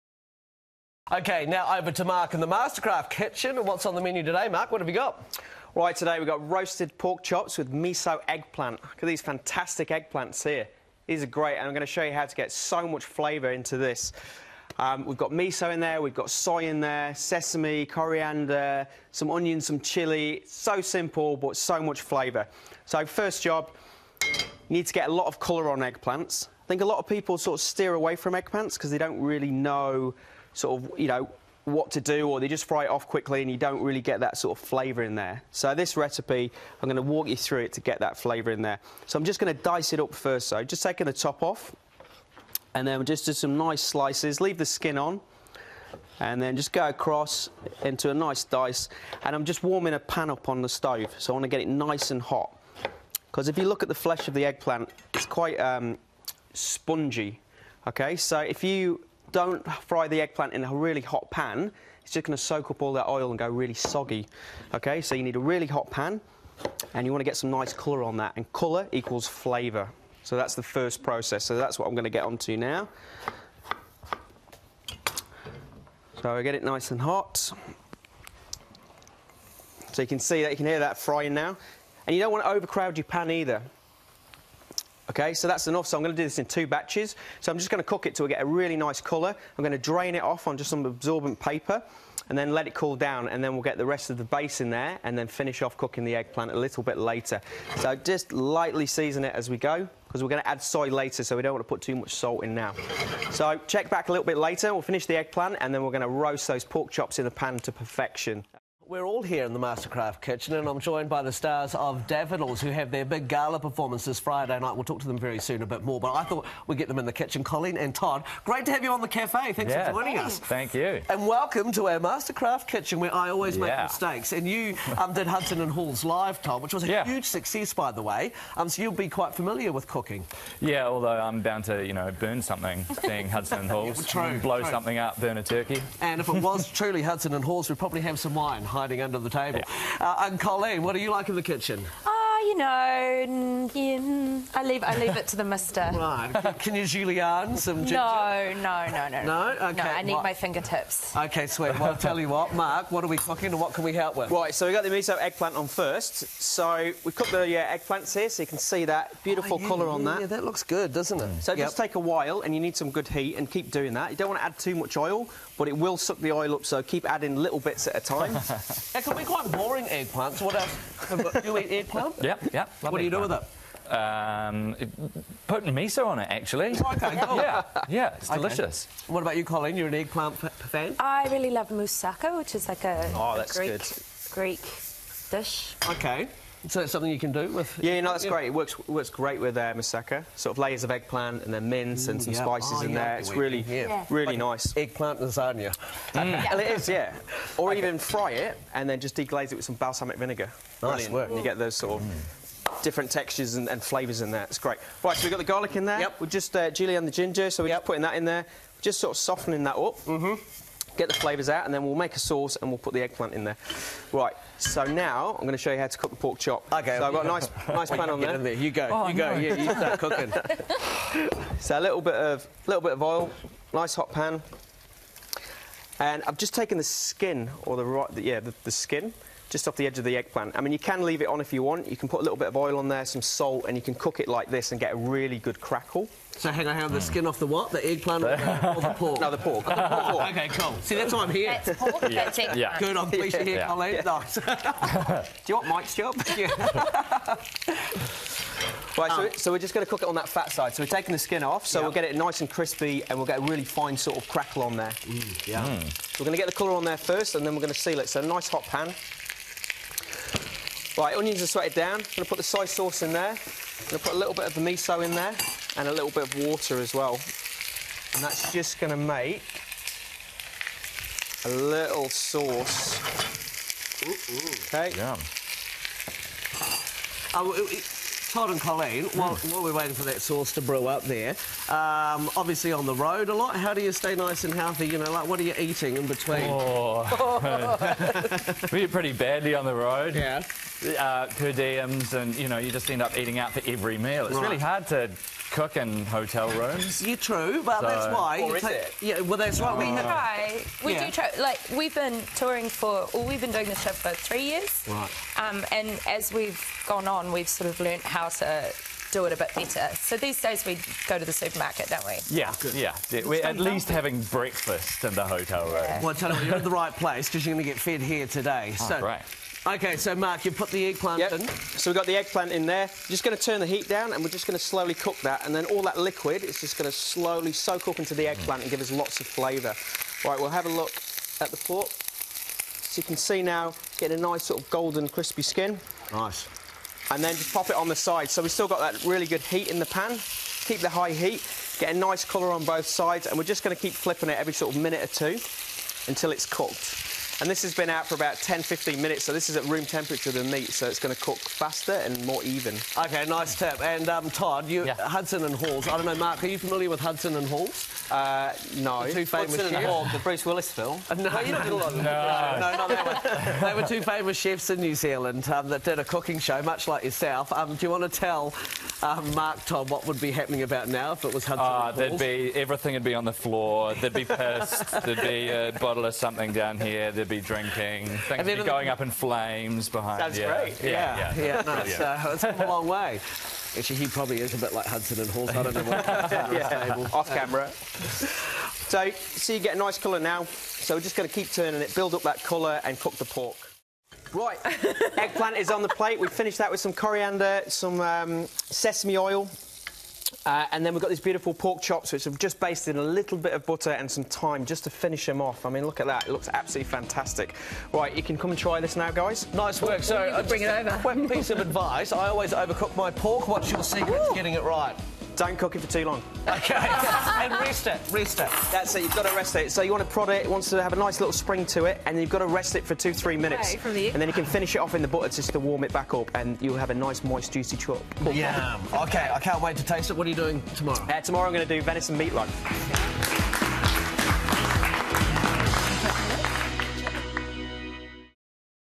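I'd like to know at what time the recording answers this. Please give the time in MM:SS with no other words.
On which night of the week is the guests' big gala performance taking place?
01:54.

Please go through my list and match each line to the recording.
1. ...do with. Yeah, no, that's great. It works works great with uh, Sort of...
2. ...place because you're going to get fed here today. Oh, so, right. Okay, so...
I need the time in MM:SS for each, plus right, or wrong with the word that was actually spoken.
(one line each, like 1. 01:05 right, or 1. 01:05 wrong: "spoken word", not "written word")
1. 03:07 right
2. 05:16 right.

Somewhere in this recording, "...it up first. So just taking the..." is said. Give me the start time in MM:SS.
00:39.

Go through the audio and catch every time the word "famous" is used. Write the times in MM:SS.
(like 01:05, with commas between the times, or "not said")
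05:59, 06:04.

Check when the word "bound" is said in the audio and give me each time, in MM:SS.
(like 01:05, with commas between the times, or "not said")
02:11.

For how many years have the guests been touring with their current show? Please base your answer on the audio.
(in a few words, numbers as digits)
3.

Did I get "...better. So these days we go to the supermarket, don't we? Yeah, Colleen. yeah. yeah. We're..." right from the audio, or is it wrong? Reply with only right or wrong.
wrong.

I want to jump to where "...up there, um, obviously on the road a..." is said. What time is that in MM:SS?
04:40.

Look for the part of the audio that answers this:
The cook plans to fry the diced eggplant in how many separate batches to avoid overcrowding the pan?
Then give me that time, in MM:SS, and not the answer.
01:26.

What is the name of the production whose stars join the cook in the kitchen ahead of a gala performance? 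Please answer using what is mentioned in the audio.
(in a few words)
Daffodils.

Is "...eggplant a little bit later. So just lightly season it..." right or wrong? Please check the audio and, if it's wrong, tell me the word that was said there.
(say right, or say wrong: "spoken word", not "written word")
right.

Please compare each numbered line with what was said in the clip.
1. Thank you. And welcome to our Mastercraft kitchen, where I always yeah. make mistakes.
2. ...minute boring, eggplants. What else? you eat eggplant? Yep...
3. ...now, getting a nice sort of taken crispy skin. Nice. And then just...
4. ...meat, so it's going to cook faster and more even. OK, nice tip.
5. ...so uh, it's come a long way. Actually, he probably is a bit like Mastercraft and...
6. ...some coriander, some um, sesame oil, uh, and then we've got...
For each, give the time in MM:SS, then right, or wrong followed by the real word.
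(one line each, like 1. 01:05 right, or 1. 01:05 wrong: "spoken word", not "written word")
1. 02:00 right
2. 02:49 wrong: "quite", not "minute"
3. 05:33 wrong: "golden", not "taken"
4. 05:50 right
5. 06:21 wrong: "Hudson", not "Mastercraft"
6. 06:36 right.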